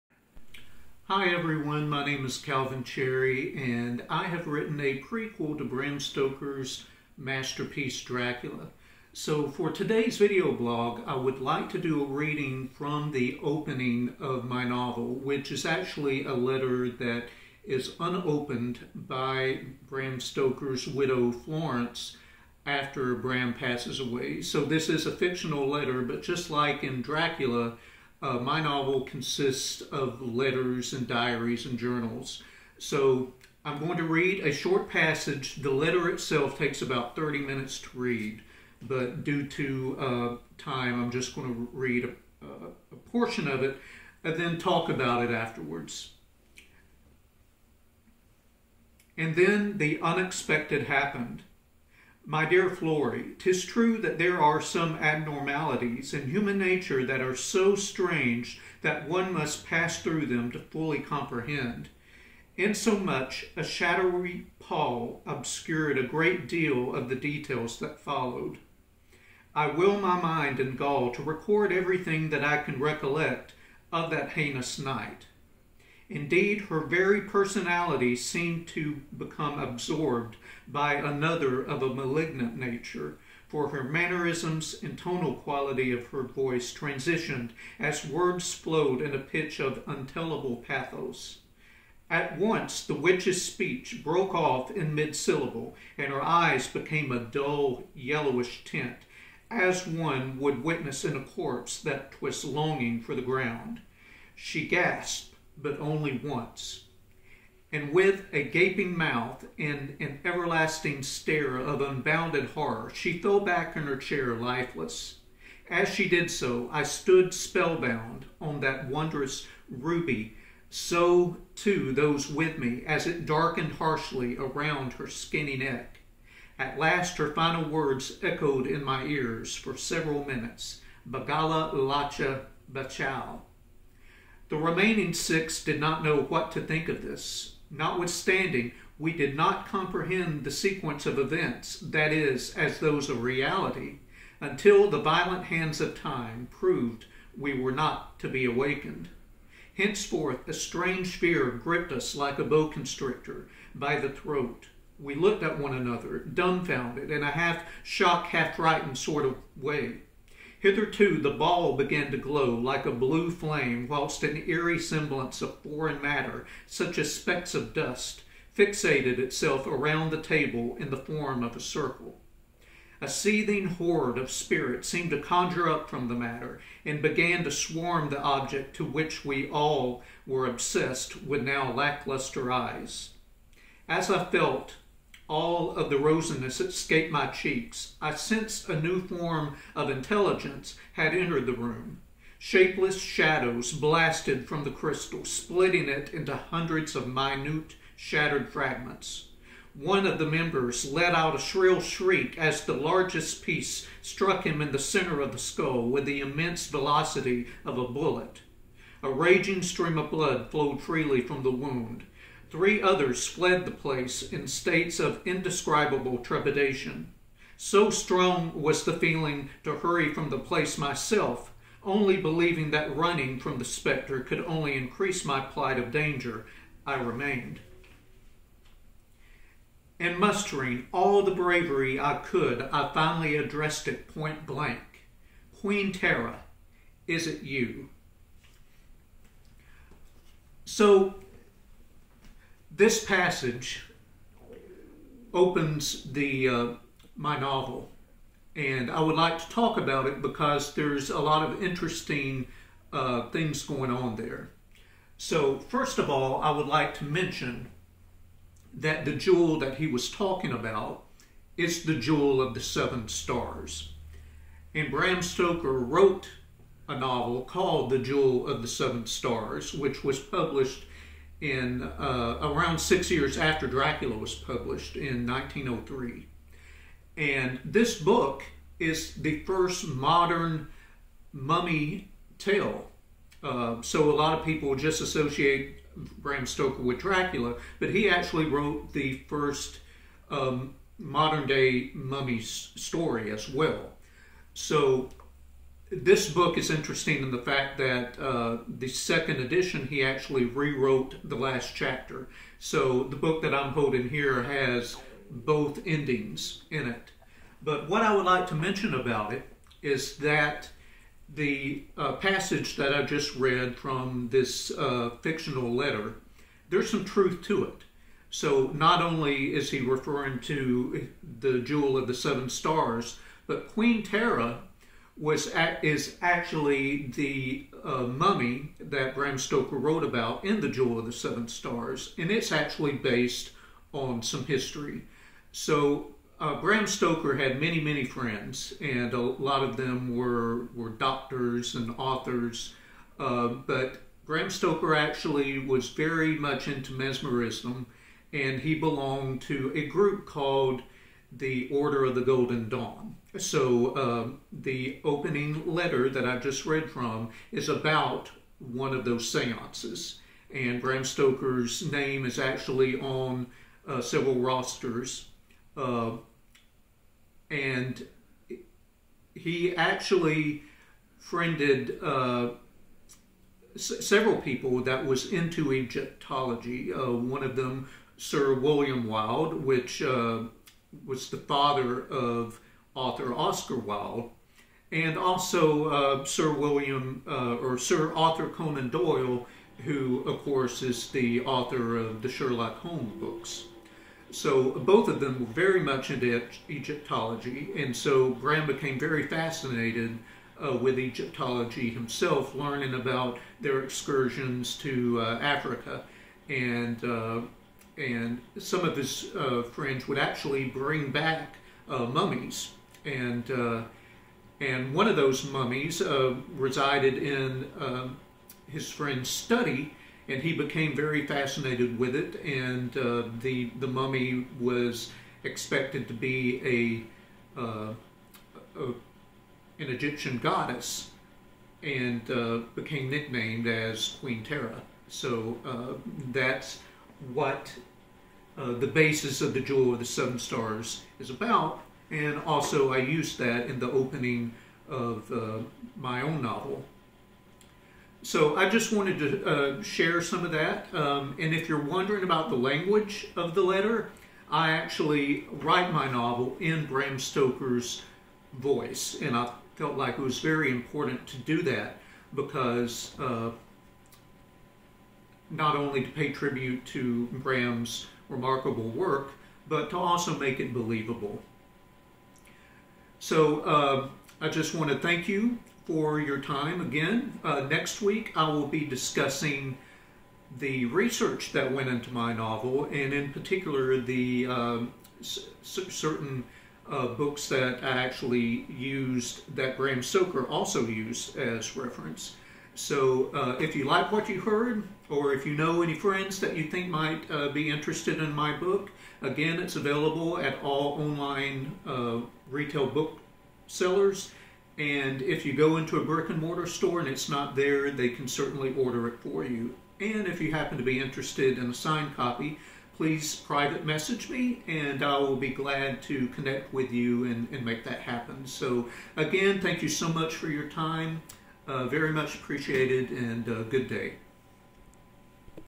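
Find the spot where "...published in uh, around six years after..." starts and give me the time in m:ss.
4:30.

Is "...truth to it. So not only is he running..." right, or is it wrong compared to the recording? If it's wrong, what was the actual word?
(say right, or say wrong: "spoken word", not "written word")
wrong: "referring", not "running".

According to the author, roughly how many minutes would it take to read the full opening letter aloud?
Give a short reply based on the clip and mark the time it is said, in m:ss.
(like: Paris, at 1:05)
30, at 0:37.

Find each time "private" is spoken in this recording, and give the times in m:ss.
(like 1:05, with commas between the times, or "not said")
8:33.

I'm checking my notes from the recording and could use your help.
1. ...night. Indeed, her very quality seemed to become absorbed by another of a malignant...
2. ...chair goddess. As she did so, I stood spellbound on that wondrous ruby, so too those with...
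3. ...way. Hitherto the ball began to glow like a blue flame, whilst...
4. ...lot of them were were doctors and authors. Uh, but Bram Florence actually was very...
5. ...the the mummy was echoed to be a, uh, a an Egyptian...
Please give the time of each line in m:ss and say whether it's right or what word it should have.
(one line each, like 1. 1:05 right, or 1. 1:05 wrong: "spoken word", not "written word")
1. 1:14 wrong: "personality", not "quality"
2. 1:53 wrong: "lifeless", not "goddess"
3. 2:39 right
4. 5:39 wrong: "Stoker", not "Florence"
5. 7:03 wrong: "expected", not "echoed".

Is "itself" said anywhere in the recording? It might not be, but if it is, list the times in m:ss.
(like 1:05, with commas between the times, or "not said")
0:36, 2:49.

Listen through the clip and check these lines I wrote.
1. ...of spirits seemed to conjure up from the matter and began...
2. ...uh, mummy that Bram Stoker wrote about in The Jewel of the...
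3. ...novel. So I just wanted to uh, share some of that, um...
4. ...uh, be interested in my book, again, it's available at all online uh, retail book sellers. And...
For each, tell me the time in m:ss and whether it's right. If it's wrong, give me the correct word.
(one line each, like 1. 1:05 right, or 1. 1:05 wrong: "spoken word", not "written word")
1. 2:54 right
2. 5:27 right
3. 7:26 right
4. 8:17 right.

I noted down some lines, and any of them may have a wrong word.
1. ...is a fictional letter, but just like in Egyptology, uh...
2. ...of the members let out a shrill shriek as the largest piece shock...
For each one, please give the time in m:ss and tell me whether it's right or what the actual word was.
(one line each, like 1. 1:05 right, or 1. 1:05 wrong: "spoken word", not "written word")
1. 0:24 wrong: "Dracula", not "Egyptology"
2. 3:20 wrong: "struck", not "shock".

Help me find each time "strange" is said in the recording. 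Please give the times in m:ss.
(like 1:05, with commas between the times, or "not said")
0:57, 2:30.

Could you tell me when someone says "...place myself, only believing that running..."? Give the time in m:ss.
3:40.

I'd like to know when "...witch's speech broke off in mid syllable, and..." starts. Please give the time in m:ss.
1:32.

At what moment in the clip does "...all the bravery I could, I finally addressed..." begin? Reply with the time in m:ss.
3:50.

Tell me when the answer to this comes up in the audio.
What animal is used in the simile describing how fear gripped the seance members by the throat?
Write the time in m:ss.
2:32.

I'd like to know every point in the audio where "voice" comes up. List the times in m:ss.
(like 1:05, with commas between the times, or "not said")
1:26, 7:38.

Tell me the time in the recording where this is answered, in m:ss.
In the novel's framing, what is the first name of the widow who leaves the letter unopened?
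0:21.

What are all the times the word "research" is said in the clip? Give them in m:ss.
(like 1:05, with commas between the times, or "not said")
8:00.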